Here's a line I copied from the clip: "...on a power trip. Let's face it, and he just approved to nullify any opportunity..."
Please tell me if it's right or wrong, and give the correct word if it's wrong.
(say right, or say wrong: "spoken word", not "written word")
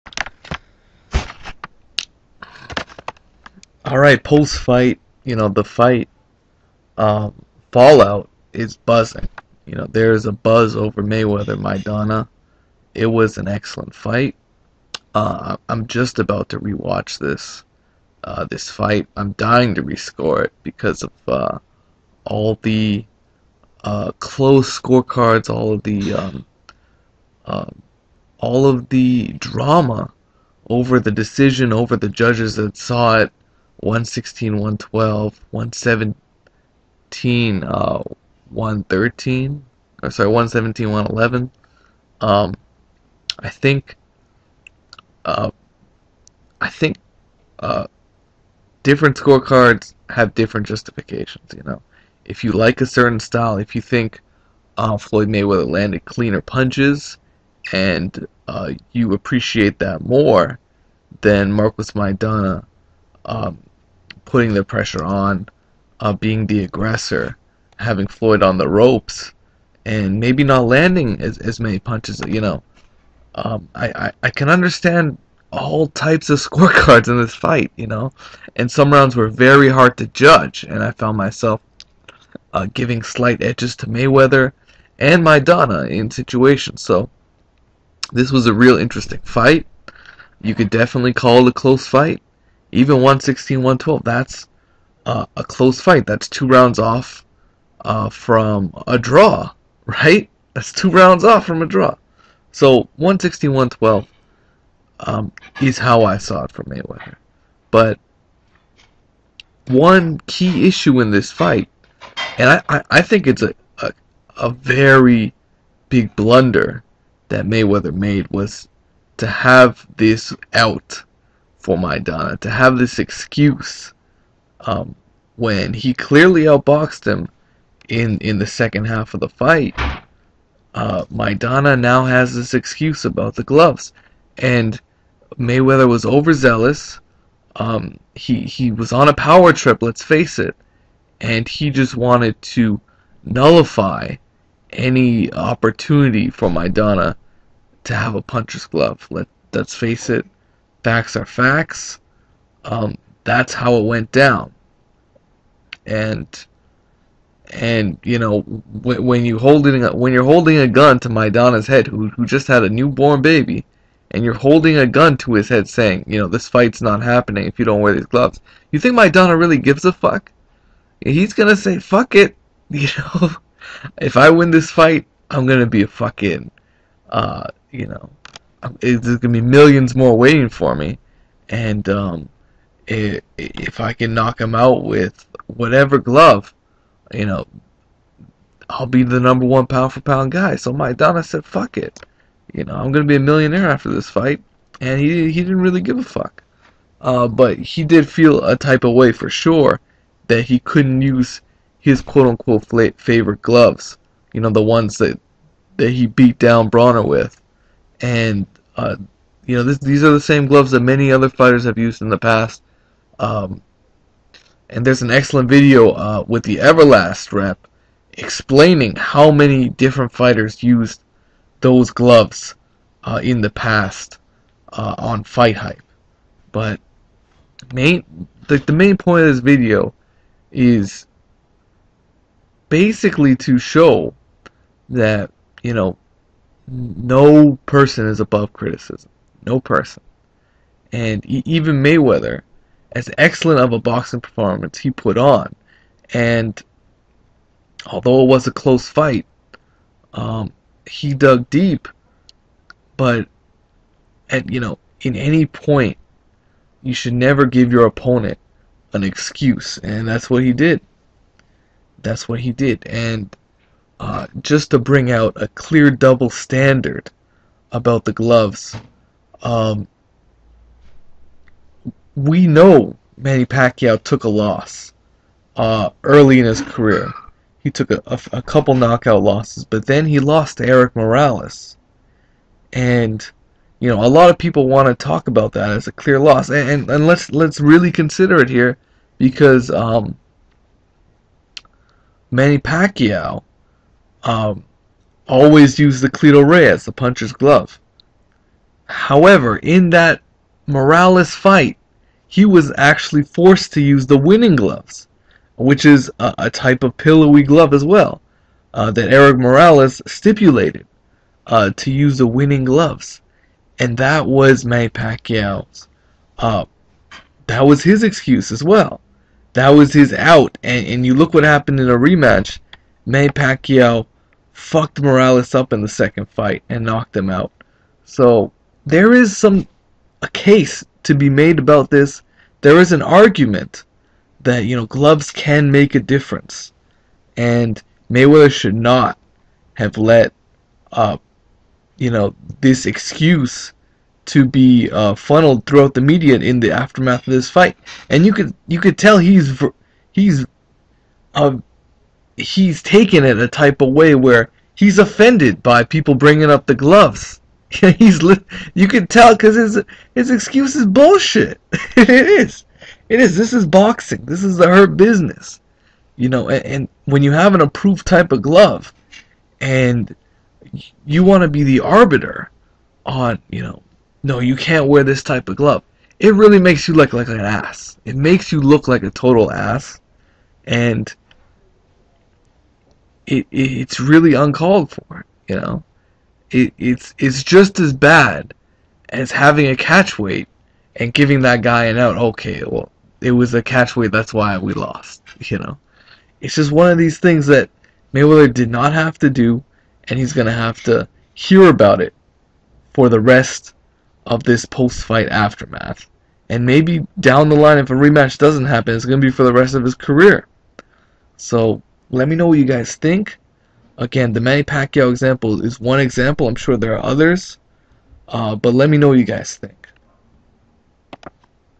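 wrong: "wanted", not "approved".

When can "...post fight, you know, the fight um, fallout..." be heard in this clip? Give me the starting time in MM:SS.
00:04.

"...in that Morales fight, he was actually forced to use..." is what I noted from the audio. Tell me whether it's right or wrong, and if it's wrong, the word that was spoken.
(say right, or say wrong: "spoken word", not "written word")
right.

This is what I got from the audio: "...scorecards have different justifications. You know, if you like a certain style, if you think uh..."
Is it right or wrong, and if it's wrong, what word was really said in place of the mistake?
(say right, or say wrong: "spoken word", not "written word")
right.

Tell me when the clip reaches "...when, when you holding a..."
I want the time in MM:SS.
02:38.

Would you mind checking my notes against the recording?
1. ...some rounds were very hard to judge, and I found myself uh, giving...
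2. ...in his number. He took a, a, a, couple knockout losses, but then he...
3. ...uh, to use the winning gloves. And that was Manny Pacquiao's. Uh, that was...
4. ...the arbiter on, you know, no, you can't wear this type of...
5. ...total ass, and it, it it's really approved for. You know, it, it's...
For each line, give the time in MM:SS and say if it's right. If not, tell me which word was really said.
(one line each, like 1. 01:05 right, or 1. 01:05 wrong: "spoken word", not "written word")
1. 01:18 right
2. 04:36 wrong: "career", not "number"
3. 05:11 right
4. 06:11 right
5. 06:19 wrong: "uncalled", not "approved".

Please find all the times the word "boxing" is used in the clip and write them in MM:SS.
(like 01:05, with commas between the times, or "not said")
04:03, 06:03.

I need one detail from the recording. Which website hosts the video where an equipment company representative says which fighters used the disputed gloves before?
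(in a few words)
Fight Hype.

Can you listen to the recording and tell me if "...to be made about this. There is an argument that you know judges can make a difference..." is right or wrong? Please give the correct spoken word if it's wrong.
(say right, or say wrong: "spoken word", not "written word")
wrong: "gloves", not "judges".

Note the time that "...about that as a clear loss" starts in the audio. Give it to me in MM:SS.
04:45.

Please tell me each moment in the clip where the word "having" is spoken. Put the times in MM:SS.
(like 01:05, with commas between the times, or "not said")
01:07, 06:29.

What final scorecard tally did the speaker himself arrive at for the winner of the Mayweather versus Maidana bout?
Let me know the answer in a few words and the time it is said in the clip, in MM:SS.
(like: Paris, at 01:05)
116-112, at 01:42.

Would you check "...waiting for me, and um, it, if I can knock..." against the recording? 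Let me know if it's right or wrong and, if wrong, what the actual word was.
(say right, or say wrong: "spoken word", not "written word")
right.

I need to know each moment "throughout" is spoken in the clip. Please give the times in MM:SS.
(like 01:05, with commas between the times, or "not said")
05:45.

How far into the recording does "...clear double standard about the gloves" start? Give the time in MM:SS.
04:25.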